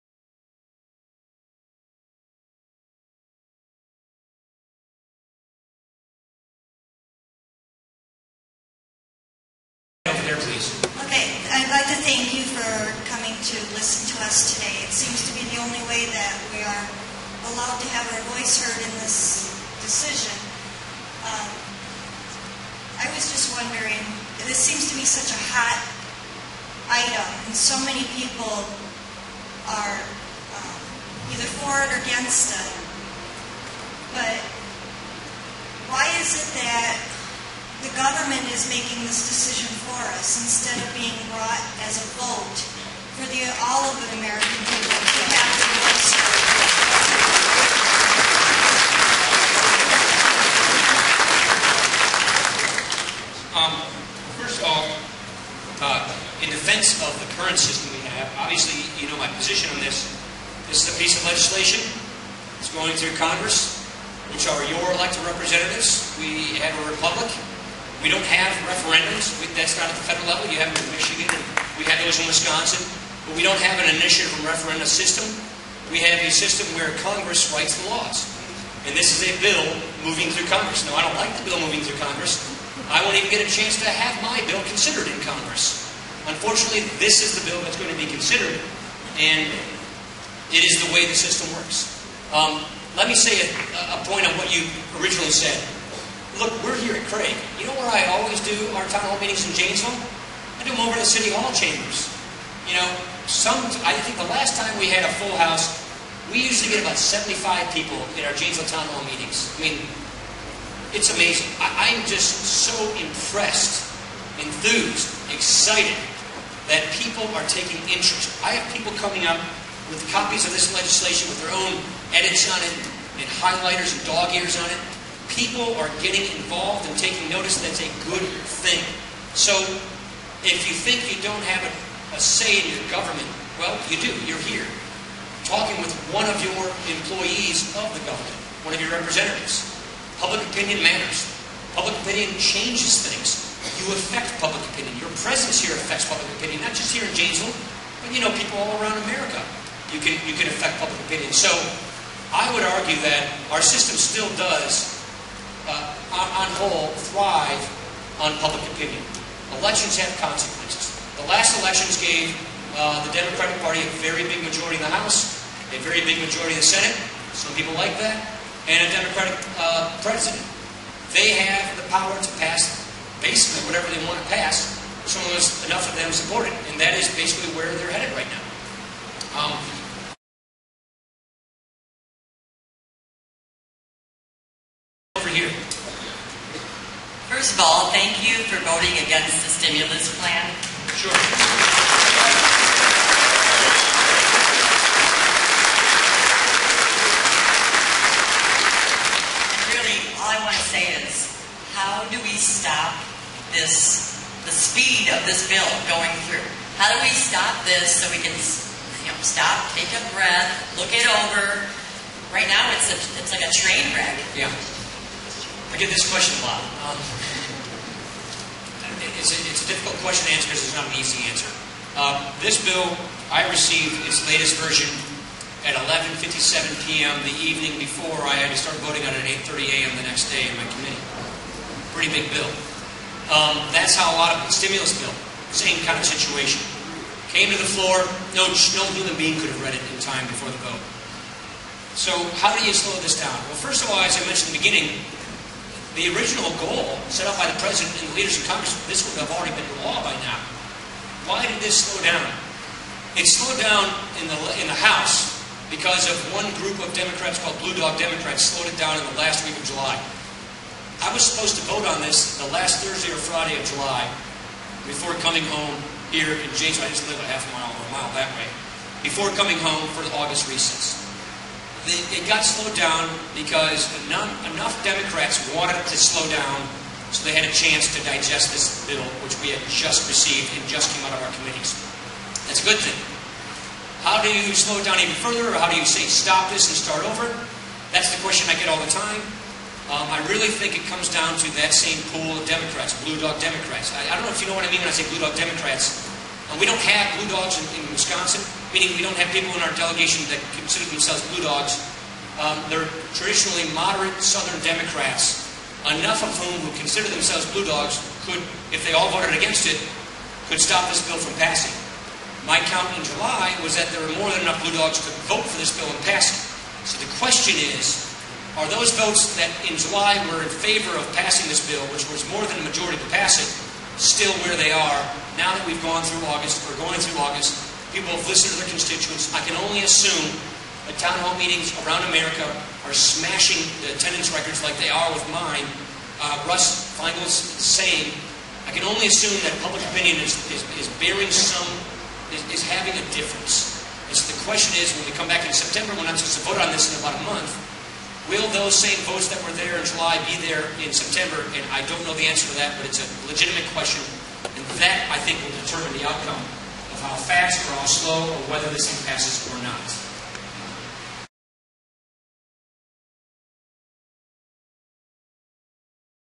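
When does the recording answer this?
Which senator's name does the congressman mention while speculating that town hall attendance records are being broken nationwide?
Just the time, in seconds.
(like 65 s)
336 s.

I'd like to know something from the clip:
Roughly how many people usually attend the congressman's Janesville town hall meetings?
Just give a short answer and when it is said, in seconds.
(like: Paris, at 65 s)
75, at 106 s.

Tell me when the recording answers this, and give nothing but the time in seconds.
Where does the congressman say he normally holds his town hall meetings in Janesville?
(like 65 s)
101 s.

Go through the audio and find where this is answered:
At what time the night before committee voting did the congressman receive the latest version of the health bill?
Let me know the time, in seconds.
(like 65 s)
225 s.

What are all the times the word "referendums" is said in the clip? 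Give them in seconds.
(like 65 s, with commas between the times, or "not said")
68 s, 74 s.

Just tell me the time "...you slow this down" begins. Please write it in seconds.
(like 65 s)
242 s.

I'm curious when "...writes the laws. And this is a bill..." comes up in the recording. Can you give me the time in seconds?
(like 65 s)
77 s.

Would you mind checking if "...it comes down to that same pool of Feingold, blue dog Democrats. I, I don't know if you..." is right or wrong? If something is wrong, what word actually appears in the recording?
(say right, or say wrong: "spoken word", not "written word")
wrong: "Democrats", not "Feingold".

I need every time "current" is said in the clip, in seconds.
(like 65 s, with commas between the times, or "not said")
57 s.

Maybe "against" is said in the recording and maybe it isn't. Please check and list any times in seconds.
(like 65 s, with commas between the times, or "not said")
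32 s, 189 s, 309 s.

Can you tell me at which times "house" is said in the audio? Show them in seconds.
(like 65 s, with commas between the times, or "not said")
105 s, 164 s, 254 s.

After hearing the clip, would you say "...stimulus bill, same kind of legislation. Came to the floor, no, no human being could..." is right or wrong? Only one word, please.
wrong.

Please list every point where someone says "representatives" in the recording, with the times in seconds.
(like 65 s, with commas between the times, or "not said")
65 s, 138 s.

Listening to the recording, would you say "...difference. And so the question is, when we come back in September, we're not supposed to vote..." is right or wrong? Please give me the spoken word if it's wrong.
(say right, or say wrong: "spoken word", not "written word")
right.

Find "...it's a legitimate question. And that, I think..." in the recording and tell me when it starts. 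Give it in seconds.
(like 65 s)
352 s.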